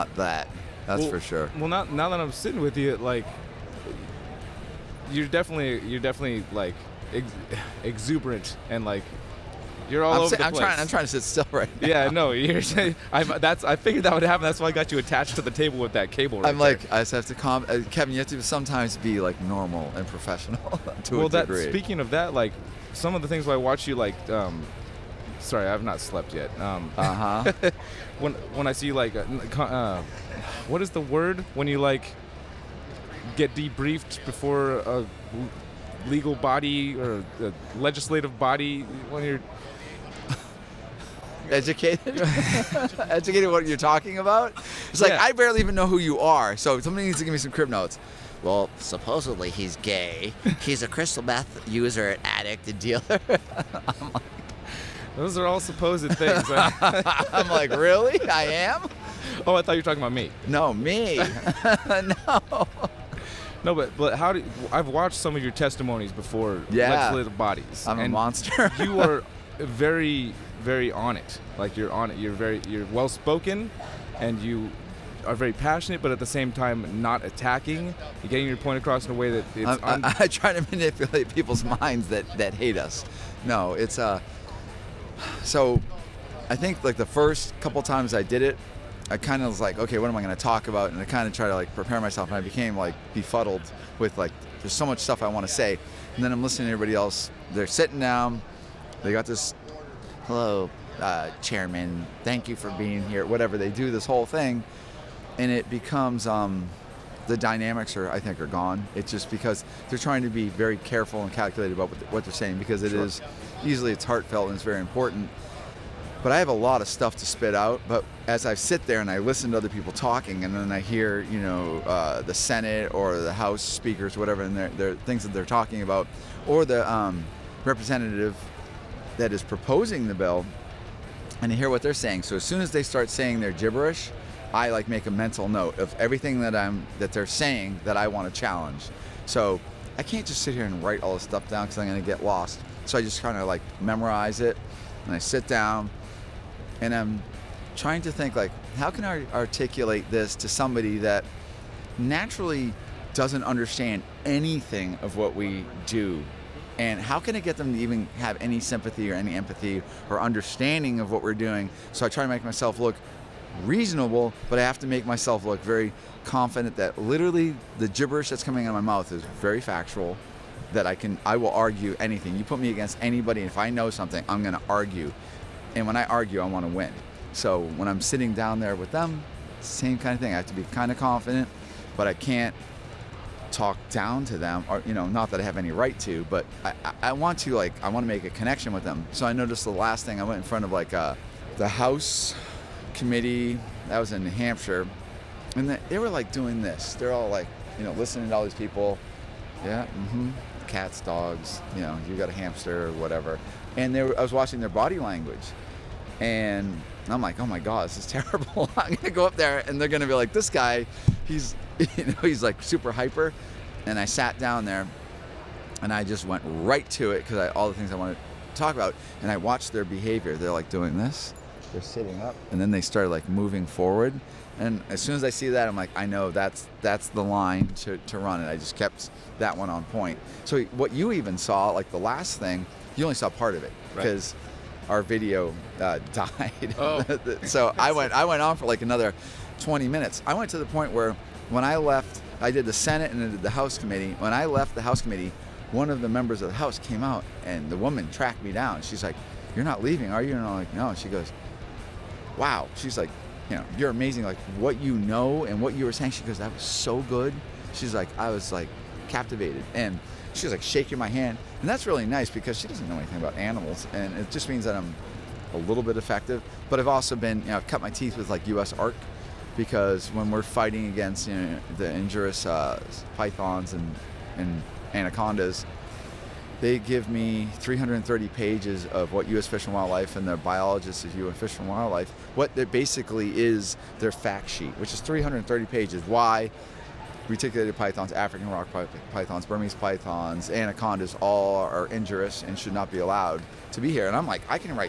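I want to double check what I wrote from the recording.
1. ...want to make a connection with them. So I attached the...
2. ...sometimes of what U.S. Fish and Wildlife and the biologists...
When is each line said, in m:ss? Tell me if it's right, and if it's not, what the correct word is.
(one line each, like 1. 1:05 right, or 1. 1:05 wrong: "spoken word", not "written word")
1. 3:07 wrong: "noticed", not "attached"
2. 4:38 wrong: "pages", not "sometimes".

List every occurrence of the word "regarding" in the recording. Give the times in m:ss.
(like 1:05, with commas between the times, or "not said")
not said.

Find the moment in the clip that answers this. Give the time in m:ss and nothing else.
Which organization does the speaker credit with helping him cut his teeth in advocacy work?
4:28.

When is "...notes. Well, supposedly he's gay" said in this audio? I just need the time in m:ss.
0:47.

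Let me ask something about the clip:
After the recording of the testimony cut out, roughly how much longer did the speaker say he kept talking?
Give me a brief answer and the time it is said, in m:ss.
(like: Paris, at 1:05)
20 minutes, at 3:59.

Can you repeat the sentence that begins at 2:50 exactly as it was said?
That I can, I will argue anything.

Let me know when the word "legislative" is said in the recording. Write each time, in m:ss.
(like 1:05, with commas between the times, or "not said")
0:37, 1:06.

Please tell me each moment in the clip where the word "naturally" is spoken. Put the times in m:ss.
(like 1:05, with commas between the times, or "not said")
2:31.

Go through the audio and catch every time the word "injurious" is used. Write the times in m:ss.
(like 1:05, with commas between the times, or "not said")
4:31, 4:51.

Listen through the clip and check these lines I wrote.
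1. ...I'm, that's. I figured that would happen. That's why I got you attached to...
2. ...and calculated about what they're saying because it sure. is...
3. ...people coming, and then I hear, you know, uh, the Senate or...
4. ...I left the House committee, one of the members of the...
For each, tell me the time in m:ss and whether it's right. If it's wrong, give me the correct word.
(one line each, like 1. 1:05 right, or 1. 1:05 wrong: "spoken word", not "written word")
1. 0:13 right
2. 1:51 right
3. 1:59 wrong: "talking", not "coming"
4. 4:04 right.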